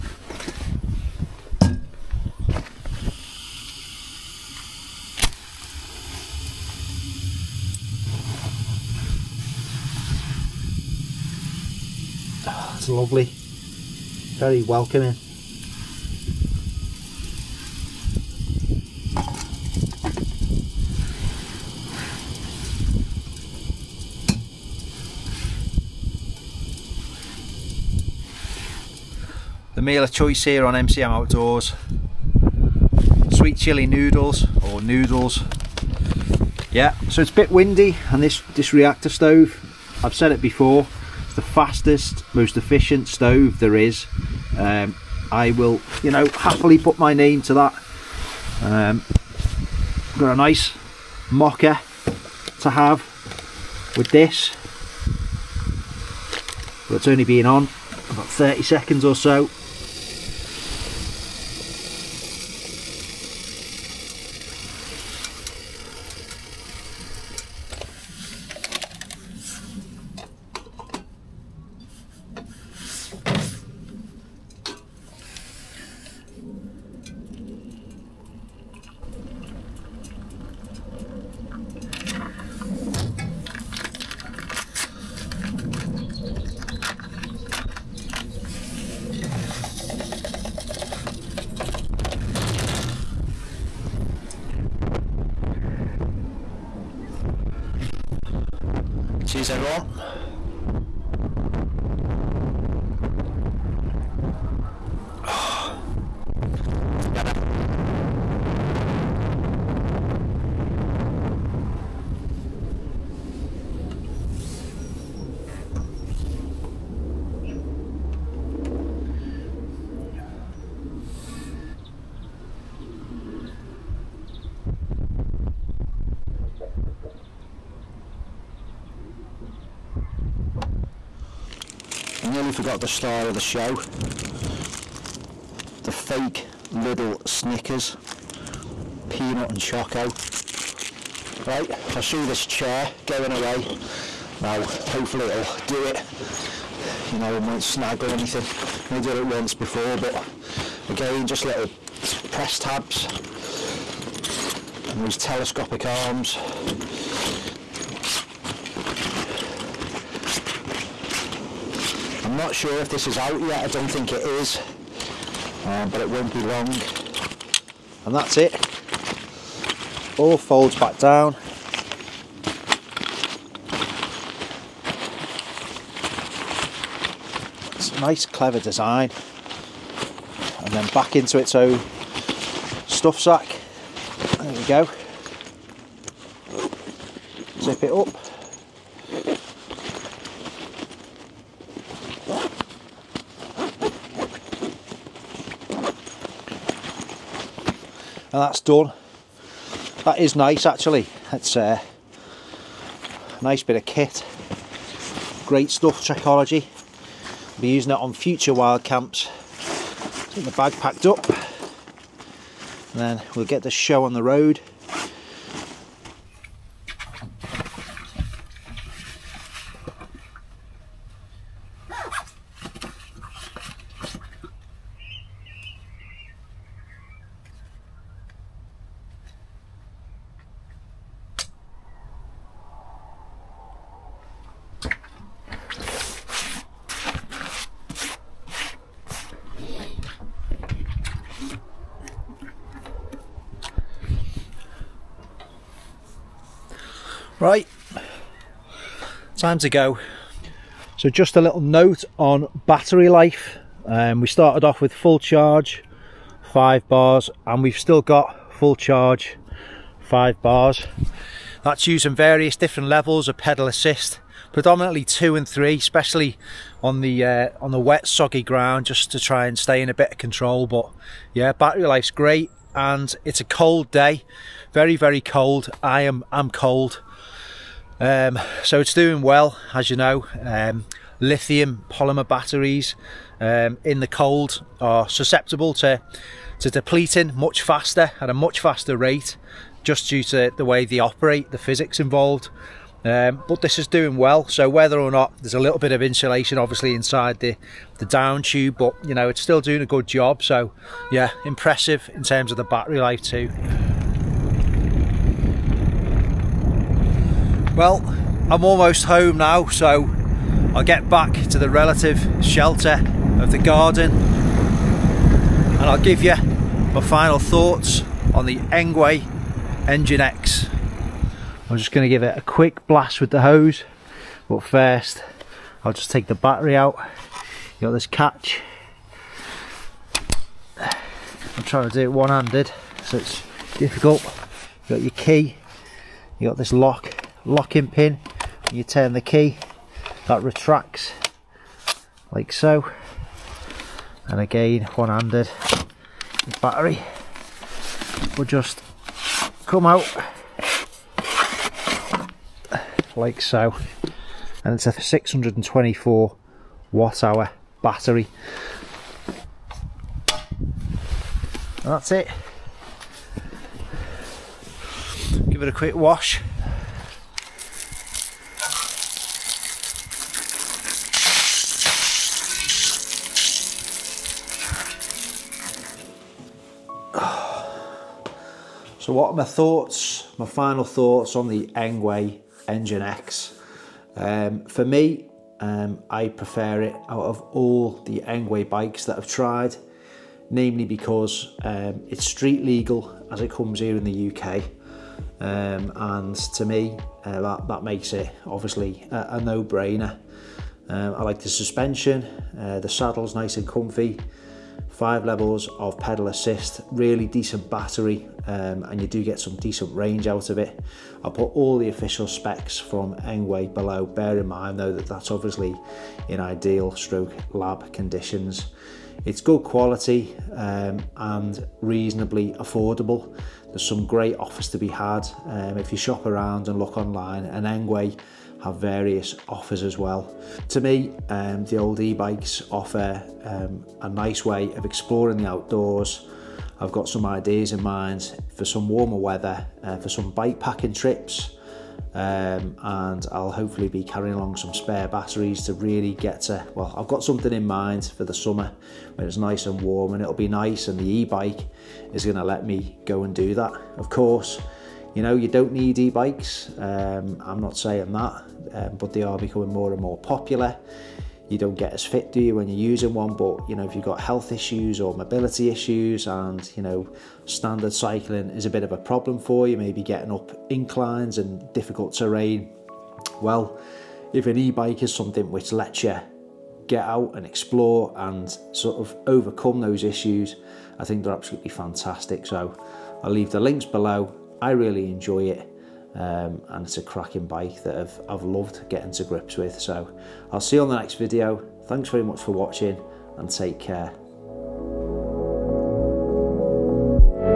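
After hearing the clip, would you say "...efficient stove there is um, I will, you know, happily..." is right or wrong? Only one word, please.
right.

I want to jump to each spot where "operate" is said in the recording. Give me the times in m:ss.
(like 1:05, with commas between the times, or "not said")
4:50.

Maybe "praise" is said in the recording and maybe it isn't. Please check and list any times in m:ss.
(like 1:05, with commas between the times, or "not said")
not said.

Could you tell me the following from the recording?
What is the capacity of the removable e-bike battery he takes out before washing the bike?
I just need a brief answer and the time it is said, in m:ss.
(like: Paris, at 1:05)
624 watt hours, at 5:54.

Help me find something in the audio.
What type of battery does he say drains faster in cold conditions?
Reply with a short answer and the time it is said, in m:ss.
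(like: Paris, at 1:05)
Lithium polymer, at 4:41.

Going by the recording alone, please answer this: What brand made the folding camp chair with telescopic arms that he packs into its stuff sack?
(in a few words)
Trekology.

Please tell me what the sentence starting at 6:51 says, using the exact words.
I'll put all the official specs from Engwe below.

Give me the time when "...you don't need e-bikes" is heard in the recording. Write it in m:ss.
7:35.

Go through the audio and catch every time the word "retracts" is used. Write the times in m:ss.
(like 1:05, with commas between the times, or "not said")
5:40.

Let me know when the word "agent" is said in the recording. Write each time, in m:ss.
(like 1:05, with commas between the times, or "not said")
not said.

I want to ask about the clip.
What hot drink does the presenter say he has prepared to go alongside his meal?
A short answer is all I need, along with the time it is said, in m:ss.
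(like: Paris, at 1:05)
Mocha, at 0:51.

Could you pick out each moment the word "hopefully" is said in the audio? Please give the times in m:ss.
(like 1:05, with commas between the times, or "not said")
2:24, 7:23.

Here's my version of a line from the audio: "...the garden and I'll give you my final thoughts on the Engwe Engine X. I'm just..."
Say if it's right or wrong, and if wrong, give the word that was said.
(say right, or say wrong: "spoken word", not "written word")
right.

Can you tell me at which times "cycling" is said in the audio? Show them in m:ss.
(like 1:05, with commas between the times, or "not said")
7:47.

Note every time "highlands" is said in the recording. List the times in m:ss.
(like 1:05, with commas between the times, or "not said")
not said.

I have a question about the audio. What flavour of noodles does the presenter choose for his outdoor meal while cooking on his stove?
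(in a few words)
Sweet chili.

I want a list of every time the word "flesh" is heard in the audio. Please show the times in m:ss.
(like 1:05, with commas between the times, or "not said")
not said.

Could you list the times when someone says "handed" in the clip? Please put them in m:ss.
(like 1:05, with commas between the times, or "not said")
5:32, 5:44.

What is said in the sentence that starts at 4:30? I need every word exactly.
But yeah, battery life's great, and it's a cold day, very very cold.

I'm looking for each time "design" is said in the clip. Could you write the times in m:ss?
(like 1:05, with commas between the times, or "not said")
2:58.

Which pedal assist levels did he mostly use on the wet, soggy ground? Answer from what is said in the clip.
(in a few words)
2 and 3.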